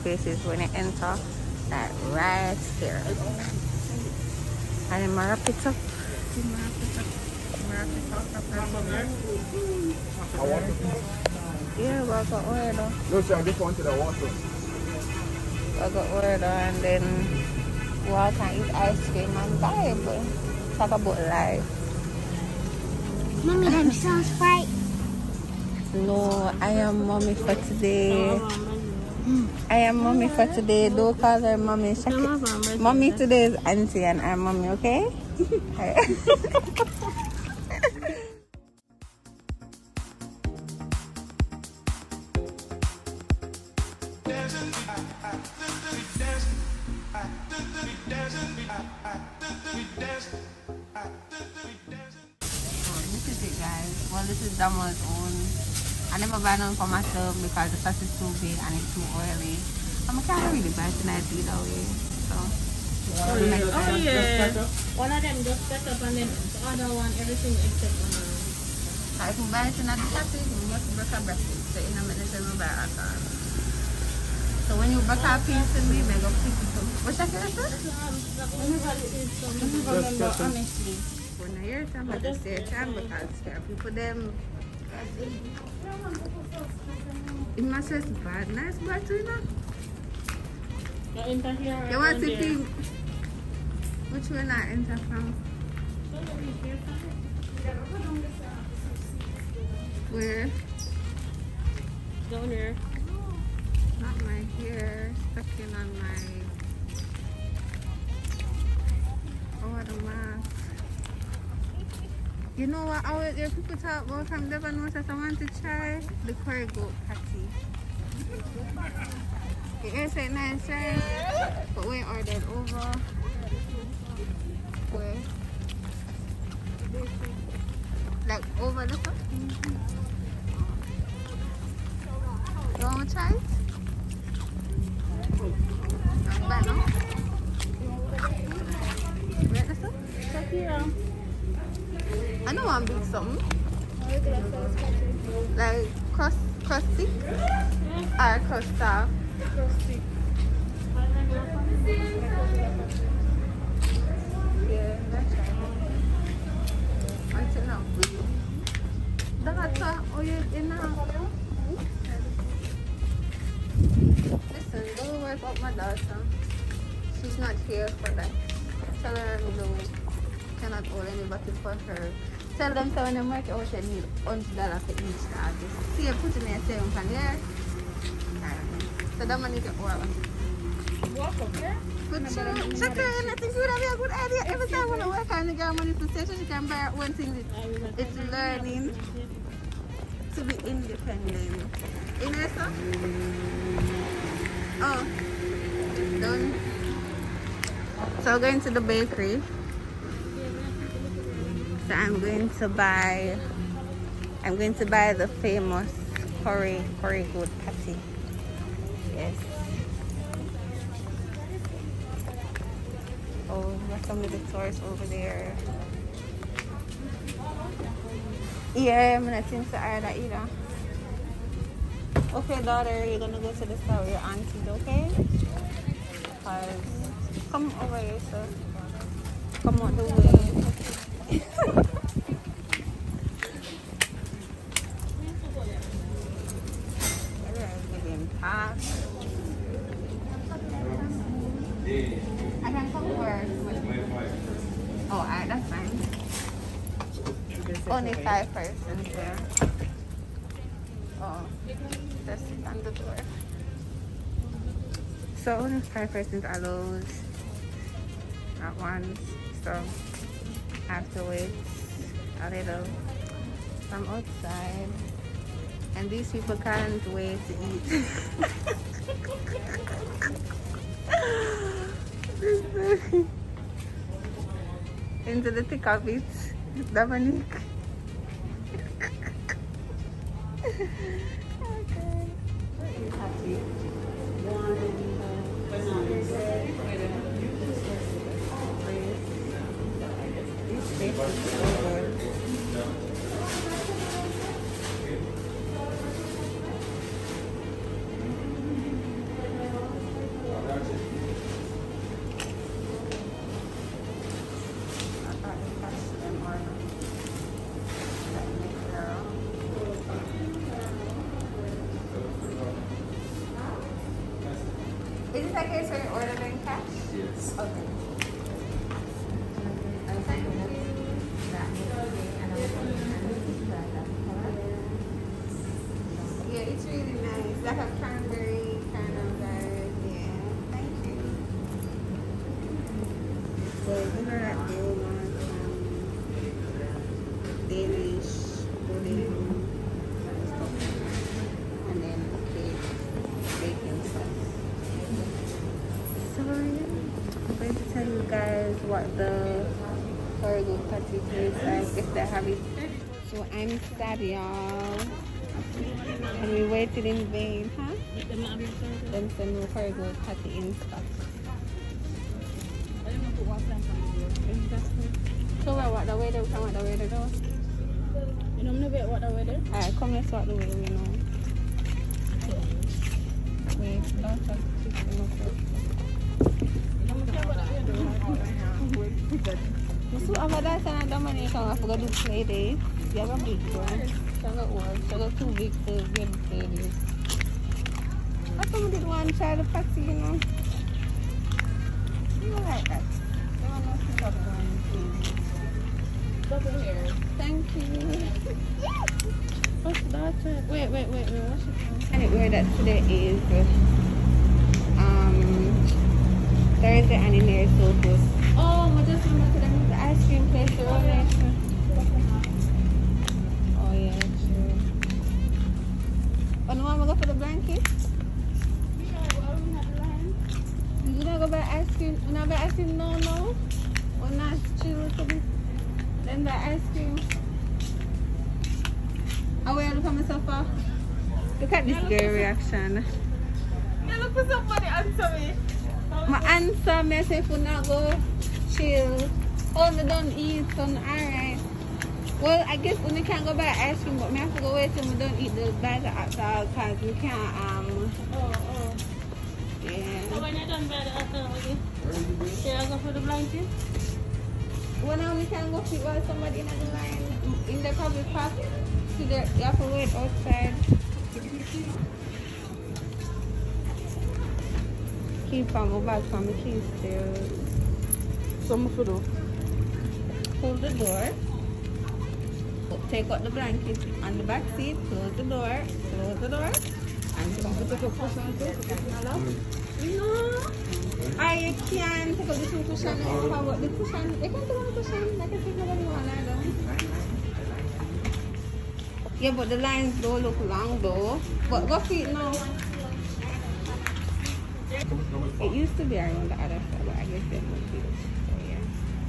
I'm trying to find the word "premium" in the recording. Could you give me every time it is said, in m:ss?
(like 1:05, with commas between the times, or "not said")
not said.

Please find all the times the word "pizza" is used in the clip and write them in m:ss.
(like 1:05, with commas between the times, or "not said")
0:05.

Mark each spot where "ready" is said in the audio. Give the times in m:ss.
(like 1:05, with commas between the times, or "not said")
6:26.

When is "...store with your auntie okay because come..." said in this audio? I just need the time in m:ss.
3:43.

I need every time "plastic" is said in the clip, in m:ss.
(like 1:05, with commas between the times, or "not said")
1:10.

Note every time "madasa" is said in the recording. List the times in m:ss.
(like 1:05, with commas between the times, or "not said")
6:20.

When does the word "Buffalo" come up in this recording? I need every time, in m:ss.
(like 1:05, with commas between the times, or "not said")
not said.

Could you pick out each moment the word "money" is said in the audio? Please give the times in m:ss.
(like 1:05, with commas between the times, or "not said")
2:59, 3:05.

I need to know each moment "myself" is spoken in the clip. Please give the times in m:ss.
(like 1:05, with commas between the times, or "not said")
0:56, 7:10.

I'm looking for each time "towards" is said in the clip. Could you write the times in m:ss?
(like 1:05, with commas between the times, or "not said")
not said.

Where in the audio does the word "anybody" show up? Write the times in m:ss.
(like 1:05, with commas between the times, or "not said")
2:51.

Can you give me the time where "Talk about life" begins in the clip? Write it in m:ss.
0:20.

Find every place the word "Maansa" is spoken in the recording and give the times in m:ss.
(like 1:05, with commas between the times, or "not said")
7:16.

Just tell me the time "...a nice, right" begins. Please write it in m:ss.
2:00.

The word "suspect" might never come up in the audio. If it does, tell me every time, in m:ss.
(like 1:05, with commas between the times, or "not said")
not said.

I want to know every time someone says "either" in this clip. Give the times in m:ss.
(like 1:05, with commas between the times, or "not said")
1:01, 3:40, 8:06.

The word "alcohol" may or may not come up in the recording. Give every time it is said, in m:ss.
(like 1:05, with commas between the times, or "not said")
7:26, 7:31.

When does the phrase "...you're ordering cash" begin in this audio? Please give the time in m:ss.
5:15.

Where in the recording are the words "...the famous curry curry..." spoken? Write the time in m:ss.
3:25.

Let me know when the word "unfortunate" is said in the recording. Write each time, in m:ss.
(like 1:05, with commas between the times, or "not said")
not said.